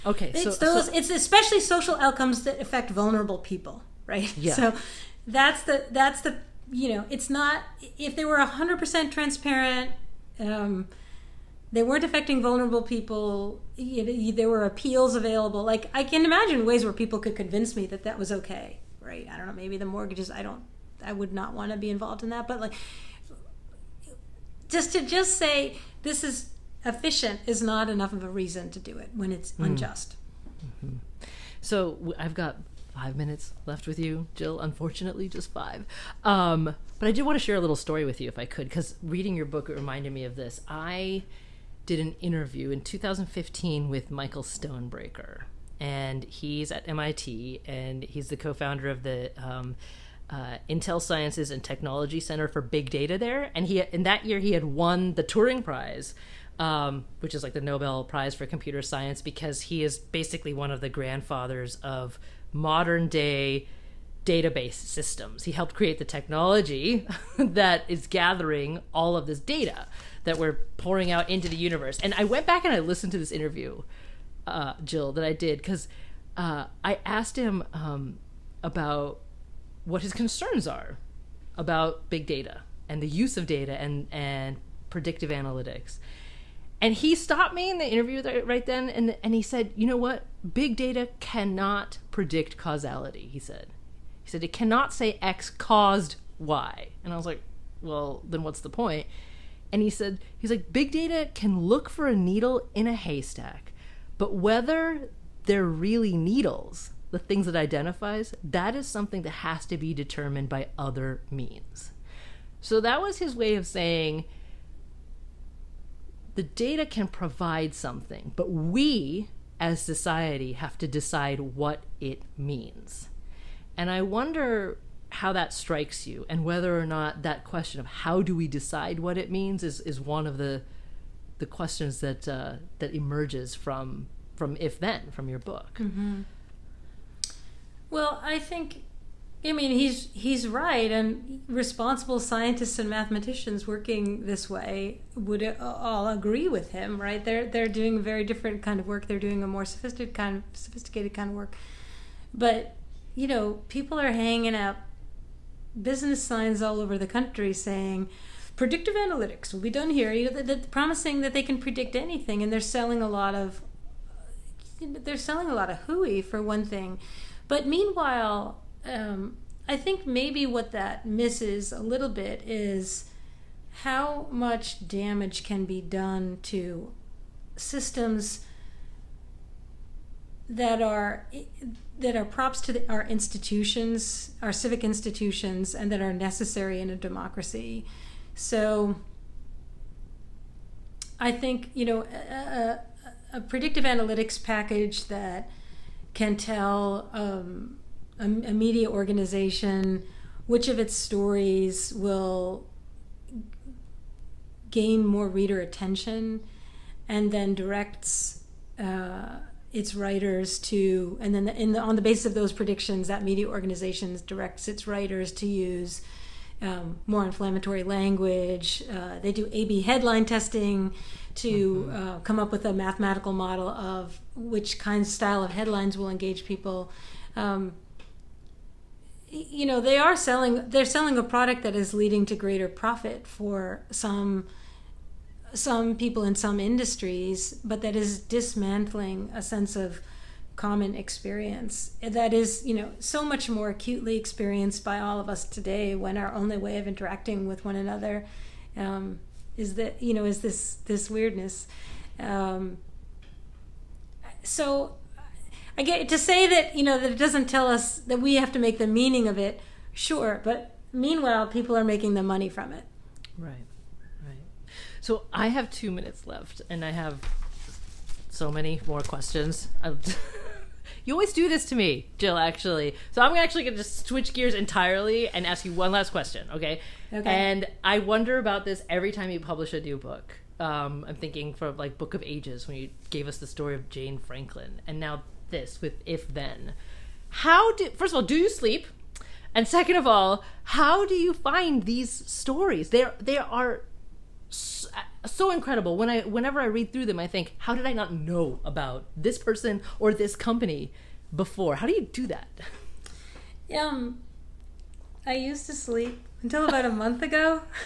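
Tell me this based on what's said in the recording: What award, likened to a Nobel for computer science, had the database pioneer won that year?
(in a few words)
Turing Prize.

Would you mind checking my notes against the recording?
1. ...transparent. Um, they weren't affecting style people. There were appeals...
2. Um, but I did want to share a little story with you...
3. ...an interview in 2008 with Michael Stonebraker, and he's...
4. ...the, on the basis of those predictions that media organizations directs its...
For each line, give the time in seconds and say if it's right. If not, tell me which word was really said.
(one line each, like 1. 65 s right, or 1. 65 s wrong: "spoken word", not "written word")
1. 9 s wrong: "vulnerable", not "style"
2. 36 s right
3. 41 s wrong: "2015", not "2008"
4. 211 s right.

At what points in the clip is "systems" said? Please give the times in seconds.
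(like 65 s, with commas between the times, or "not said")
64 s, 177 s.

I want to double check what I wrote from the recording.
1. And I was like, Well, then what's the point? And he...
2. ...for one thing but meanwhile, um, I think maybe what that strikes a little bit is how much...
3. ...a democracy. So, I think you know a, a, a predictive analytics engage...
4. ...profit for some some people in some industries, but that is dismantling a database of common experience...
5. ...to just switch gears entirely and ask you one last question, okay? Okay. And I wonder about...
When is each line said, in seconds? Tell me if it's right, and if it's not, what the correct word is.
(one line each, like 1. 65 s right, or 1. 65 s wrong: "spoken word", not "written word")
1. 97 s right
2. 166 s wrong: "misses", not "strikes"
3. 186 s wrong: "package", not "engage"
4. 232 s wrong: "sense", not "database"
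5. 273 s right.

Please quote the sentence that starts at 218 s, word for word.
Uh, they do A B headline testing to mm-hmm.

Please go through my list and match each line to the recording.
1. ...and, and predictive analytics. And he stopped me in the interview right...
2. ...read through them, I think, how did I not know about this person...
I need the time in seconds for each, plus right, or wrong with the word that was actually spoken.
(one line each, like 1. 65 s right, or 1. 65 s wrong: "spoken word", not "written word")
1. 83 s right
2. 296 s right.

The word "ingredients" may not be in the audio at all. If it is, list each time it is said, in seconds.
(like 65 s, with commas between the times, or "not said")
not said.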